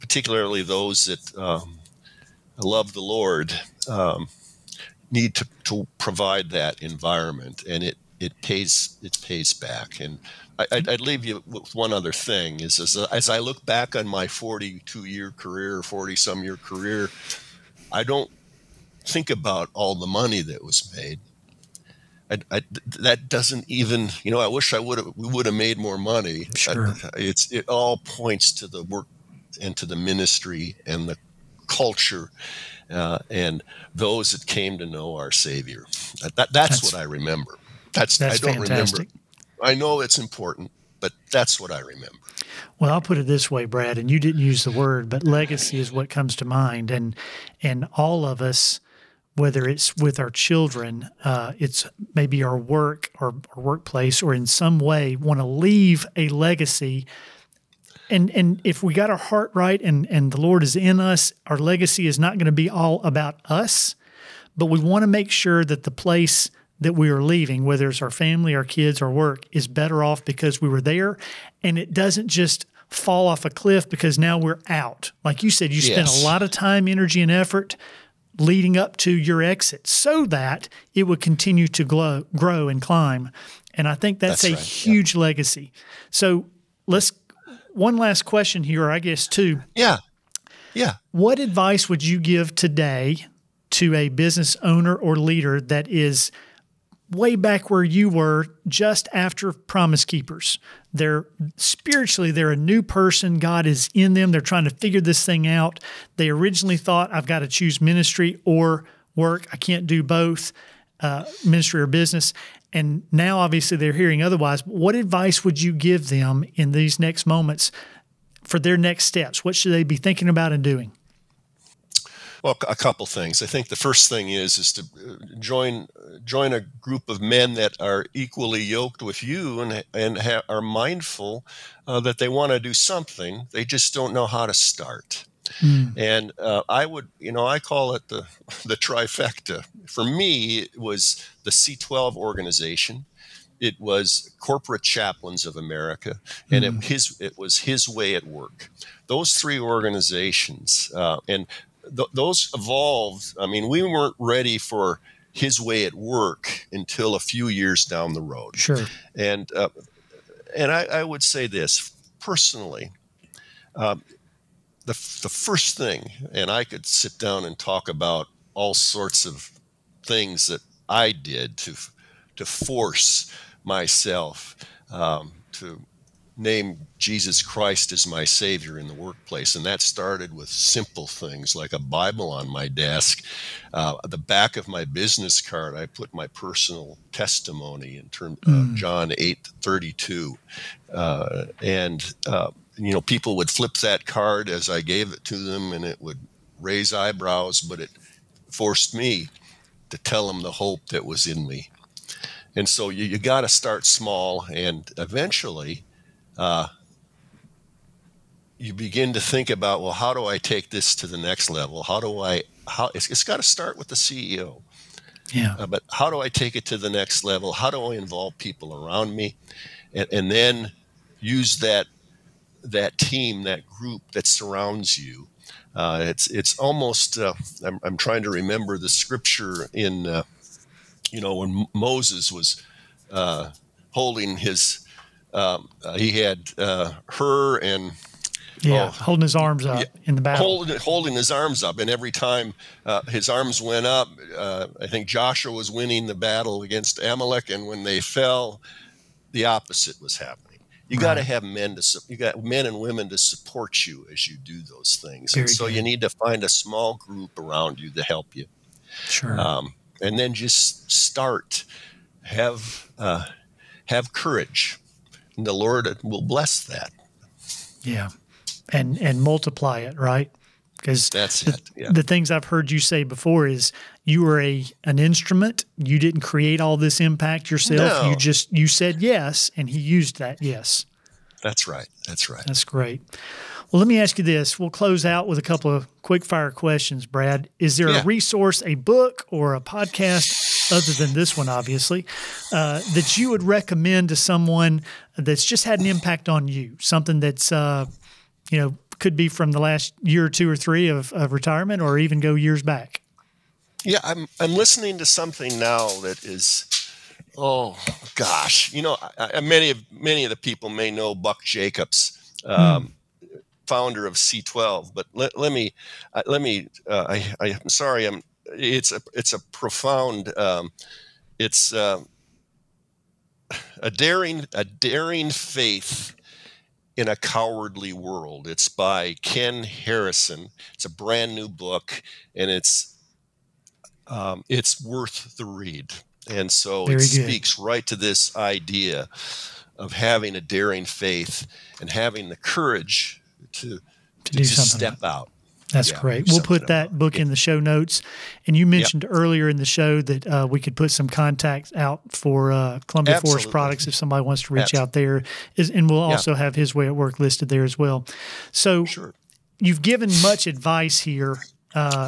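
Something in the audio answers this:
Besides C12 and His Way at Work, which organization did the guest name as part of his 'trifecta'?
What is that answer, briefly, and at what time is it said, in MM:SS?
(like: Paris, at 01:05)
Corporate Chaplains of America, at 02:24.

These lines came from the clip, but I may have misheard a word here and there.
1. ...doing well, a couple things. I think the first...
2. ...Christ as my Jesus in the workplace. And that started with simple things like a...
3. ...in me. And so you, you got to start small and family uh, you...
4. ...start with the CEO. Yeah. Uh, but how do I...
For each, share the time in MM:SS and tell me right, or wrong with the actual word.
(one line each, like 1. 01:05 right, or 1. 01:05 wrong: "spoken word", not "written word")
1. 02:00 right
2. 02:57 wrong: "Savior", not "Jesus"
3. 03:21 wrong: "eventually", not "family"
4. 03:33 right.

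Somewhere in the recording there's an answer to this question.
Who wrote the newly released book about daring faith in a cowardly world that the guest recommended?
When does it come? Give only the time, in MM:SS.
05:29.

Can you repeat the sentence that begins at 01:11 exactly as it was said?
And it doesn't just fall off a cliff because now we're out.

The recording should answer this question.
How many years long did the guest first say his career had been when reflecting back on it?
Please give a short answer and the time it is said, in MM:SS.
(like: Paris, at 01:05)
42, at 00:14.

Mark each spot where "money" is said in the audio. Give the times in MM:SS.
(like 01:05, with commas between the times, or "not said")
00:20, 00:25.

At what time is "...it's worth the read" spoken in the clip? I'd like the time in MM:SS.
05:34.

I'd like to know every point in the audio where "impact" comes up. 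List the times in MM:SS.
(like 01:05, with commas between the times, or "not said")
04:36, 04:55.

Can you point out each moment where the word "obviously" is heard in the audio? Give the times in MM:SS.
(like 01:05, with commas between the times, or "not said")
01:53, 04:51.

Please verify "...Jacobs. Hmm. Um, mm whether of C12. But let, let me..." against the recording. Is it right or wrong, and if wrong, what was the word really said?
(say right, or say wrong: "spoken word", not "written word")
wrong: "founder", not "whether".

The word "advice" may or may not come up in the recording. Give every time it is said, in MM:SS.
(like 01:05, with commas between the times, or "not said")
01:31, 01:54, 06:00.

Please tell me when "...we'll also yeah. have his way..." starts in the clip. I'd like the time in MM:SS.
05:55.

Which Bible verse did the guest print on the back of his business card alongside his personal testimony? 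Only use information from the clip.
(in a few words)
John 8:32.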